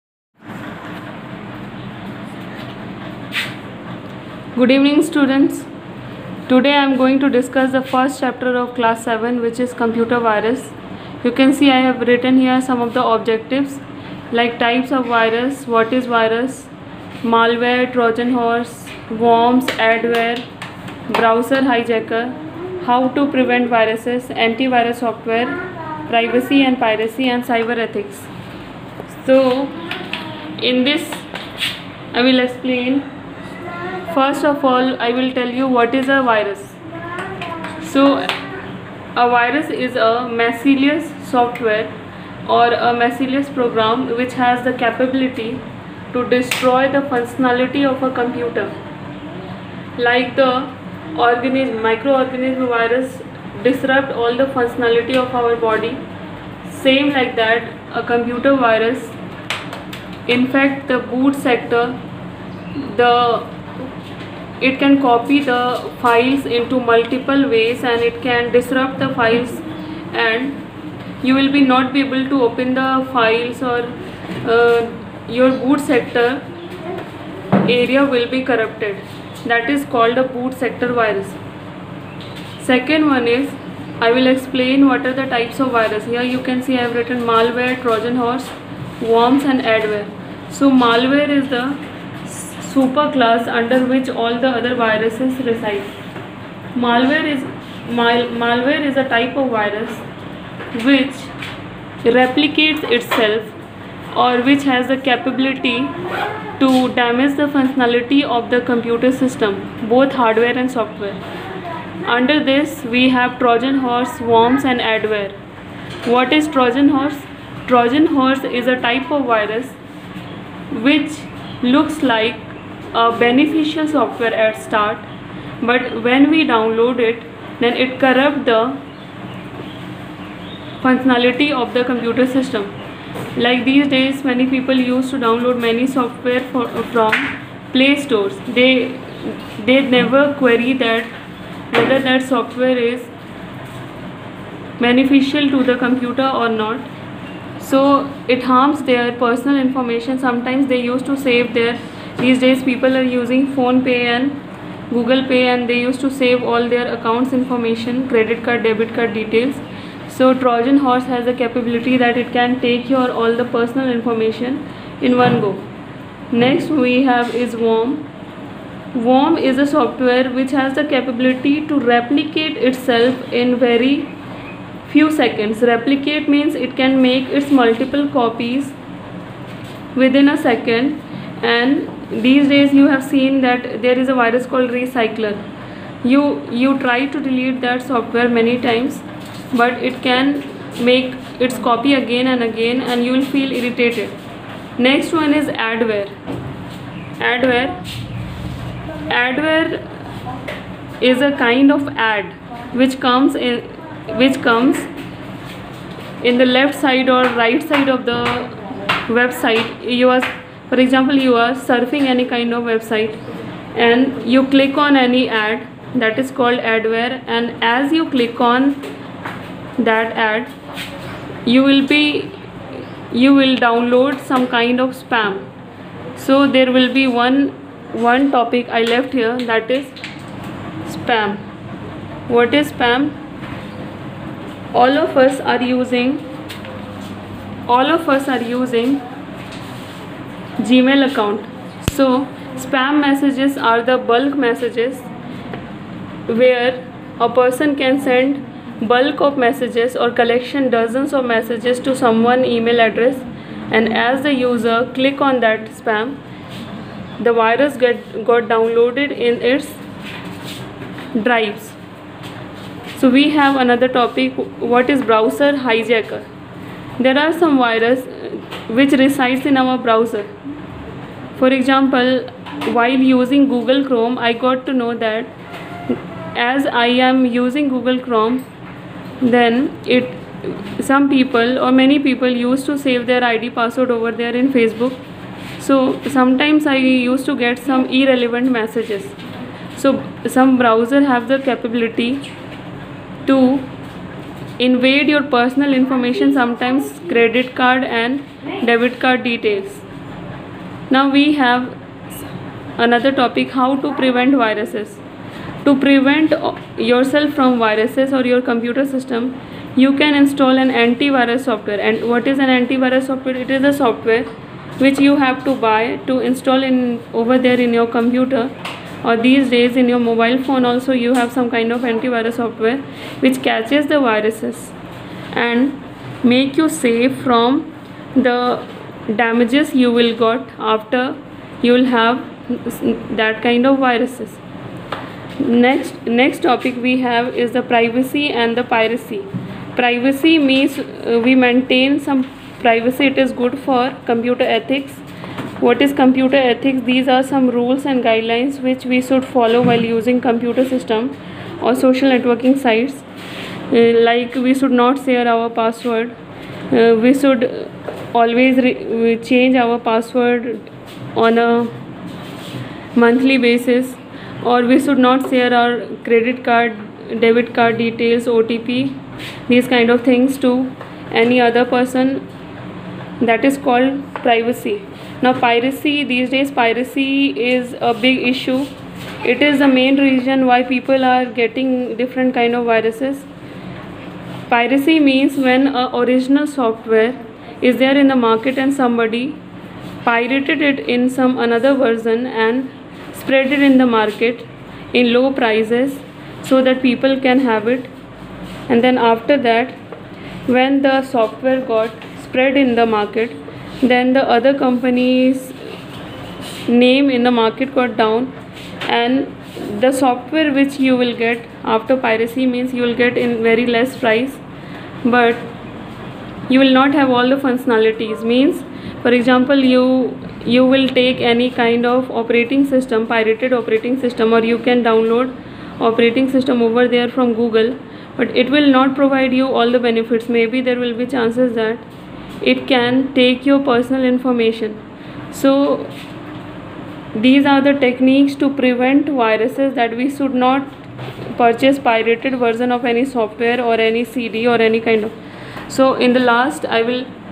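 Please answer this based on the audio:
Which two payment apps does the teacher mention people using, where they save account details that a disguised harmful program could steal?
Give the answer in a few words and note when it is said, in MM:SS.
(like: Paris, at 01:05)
PhonePe and Google Pay, at 02:33.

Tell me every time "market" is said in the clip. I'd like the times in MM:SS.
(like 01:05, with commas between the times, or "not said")
06:28, 06:33, 06:42, 06:47.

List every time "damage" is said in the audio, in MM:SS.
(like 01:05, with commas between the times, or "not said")
01:46, 05:29.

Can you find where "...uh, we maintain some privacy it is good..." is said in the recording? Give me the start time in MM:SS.
05:40.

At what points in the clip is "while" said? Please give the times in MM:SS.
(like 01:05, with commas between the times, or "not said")
04:32, 05:49.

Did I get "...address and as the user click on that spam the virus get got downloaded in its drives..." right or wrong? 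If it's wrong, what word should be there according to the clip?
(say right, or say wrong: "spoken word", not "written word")
right.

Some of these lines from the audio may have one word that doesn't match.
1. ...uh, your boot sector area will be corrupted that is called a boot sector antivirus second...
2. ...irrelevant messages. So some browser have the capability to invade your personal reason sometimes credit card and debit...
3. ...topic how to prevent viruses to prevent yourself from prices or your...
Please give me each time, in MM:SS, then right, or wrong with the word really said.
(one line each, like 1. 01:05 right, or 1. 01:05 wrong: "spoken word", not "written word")
1. 01:14 wrong: "virus", not "antivirus"
2. 04:47 wrong: "information", not "reason"
3. 05:03 wrong: "viruses", not "prices".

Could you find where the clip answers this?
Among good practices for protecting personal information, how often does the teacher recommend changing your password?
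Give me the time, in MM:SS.
06:02.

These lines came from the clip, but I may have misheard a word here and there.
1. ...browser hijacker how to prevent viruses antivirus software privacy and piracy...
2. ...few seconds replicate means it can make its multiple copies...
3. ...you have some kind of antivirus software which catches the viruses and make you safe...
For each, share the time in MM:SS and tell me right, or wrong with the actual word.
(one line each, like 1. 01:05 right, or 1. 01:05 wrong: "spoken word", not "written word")
1. 00:21 right
2. 02:54 right
3. 05:21 right.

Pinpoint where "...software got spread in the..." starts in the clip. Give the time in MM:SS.
06:41.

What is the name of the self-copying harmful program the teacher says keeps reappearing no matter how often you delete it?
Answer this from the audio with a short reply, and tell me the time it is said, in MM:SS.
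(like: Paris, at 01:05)
Recycler, at 03:04.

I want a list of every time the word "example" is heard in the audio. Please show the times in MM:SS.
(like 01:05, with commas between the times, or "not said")
03:30, 04:31, 06:59.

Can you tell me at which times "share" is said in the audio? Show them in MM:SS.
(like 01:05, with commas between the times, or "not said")
05:55, 06:05.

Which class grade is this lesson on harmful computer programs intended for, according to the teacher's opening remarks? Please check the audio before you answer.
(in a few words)
Class 7.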